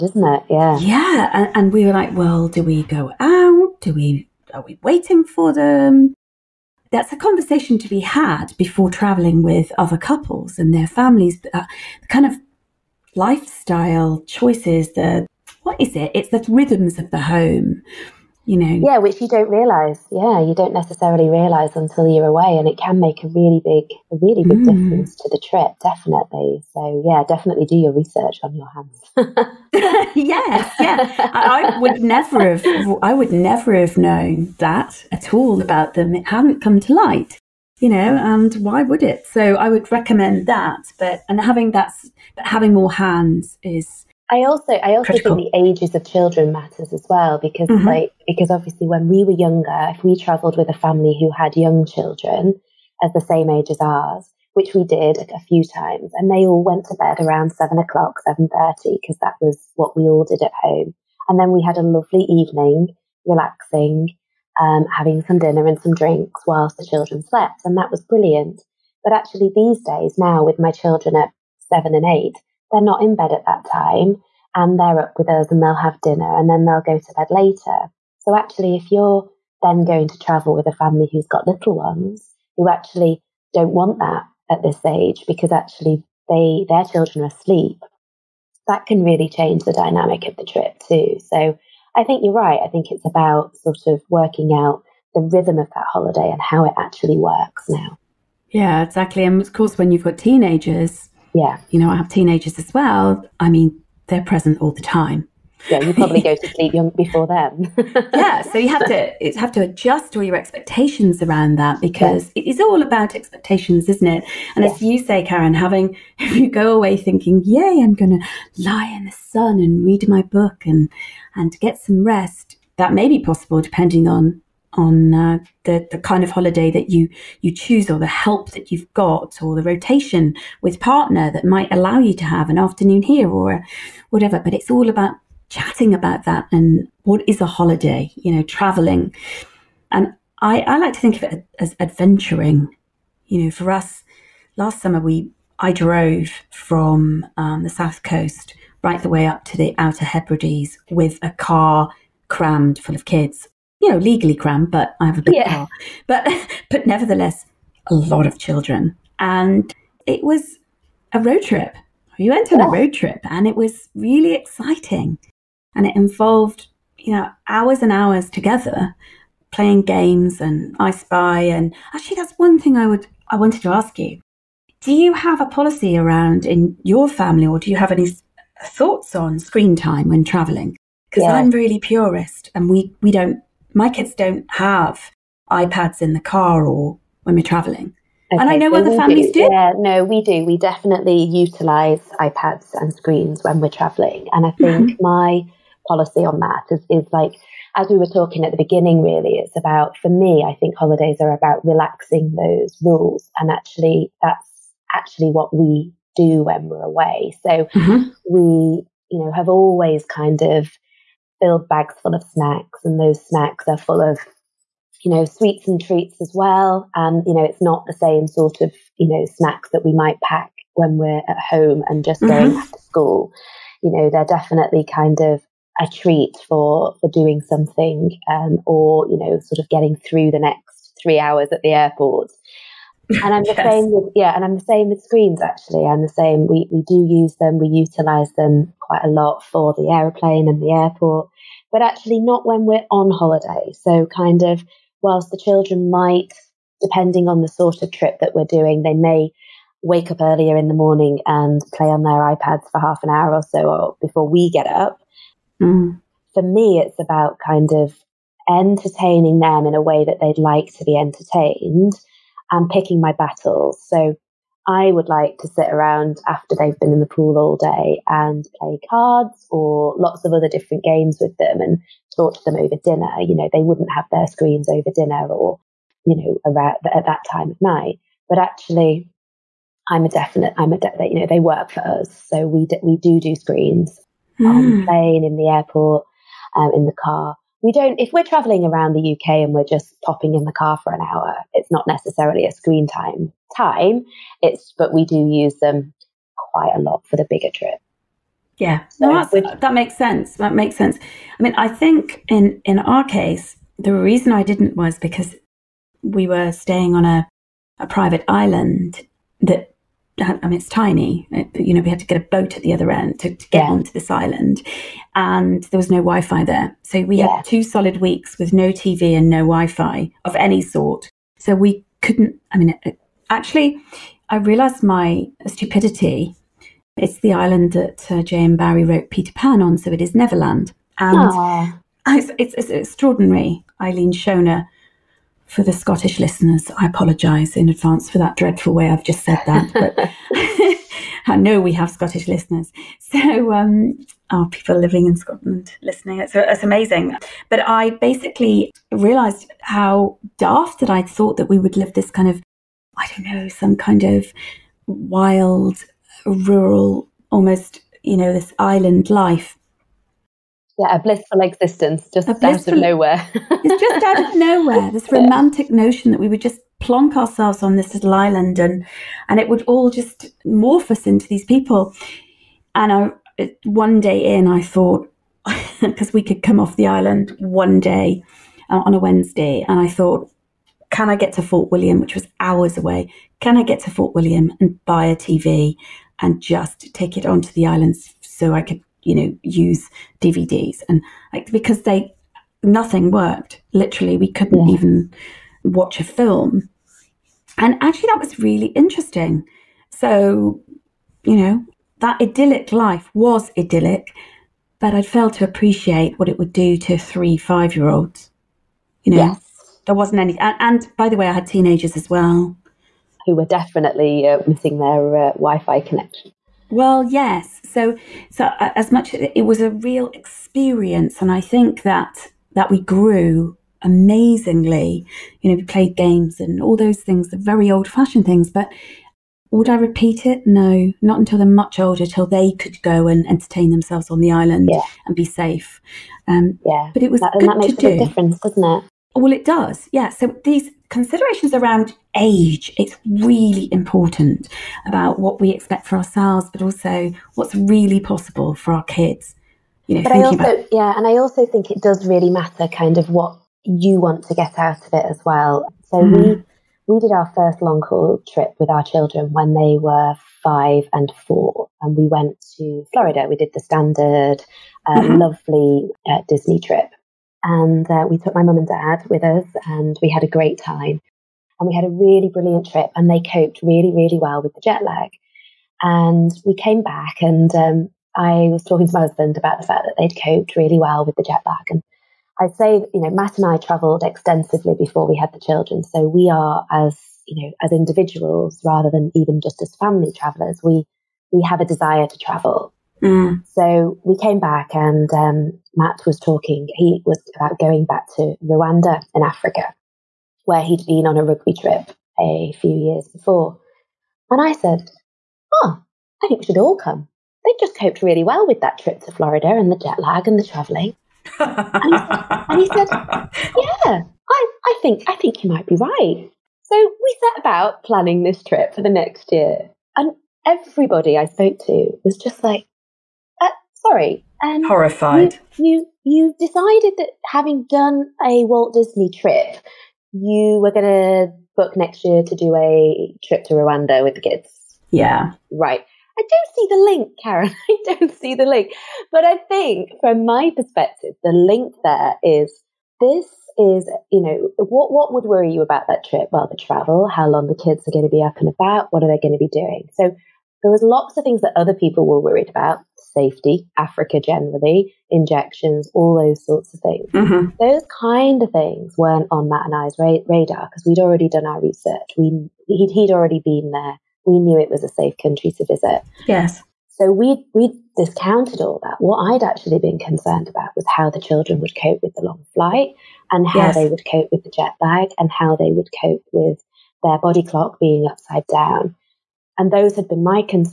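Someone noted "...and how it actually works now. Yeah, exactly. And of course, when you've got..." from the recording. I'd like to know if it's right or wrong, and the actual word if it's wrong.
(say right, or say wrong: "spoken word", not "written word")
right.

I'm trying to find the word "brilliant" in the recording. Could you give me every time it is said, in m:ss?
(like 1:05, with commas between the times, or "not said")
1:08, 7:52.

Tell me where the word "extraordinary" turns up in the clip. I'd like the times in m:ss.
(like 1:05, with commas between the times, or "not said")
5:32.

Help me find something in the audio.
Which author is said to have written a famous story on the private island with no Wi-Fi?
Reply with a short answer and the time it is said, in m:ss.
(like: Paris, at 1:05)
J.M. Barrie, at 5:28.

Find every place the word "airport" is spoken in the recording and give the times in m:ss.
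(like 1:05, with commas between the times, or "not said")
3:51, 4:00, 4:45.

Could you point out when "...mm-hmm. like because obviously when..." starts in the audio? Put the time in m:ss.
0:47.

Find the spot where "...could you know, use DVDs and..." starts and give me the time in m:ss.
6:28.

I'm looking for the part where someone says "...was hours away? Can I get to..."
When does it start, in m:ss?
6:22.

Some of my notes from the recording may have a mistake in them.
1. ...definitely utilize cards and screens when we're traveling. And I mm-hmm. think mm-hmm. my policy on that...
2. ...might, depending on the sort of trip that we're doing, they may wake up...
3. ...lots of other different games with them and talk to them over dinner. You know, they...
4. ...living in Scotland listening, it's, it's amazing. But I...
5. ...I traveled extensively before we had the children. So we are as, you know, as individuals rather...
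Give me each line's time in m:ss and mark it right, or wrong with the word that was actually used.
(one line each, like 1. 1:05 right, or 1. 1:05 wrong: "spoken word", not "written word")
1. 3:10 wrong: "iPads", not "cards"
2. 4:05 right
3. 4:29 right
4. 5:44 right
5. 8:03 right.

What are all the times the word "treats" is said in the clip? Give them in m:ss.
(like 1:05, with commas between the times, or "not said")
3:35, 3:45.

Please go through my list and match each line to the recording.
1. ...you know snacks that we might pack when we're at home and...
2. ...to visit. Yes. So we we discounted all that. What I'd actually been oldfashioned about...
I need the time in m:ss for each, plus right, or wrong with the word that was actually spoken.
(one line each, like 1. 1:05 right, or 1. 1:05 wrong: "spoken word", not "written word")
1. 3:38 right
2. 9:25 wrong: "concerned", not "oldfashioned".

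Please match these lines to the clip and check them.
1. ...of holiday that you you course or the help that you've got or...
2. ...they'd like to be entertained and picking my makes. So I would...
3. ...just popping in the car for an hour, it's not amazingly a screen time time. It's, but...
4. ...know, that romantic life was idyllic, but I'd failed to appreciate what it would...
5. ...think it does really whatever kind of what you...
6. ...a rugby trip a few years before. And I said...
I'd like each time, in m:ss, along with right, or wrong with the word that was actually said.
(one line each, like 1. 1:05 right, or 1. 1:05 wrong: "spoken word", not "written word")
1. 2:06 wrong: "choose", not "course"
2. 4:20 wrong: "battles", not "makes"
3. 4:49 wrong: "necessarily", not "amazingly"
4. 6:41 wrong: "idyllic", not "romantic"
5. 7:31 wrong: "matter", not "whatever"
6. 8:21 right.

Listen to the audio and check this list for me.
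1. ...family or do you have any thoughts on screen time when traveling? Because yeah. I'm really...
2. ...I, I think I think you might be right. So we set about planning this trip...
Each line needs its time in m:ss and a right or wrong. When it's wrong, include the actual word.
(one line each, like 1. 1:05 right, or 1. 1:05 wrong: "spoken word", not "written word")
1. 2:57 right
2. 8:34 right.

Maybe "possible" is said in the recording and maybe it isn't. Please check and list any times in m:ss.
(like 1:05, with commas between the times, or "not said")
2:03, 7:27.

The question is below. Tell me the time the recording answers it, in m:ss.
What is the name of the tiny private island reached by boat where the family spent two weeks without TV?
5:33.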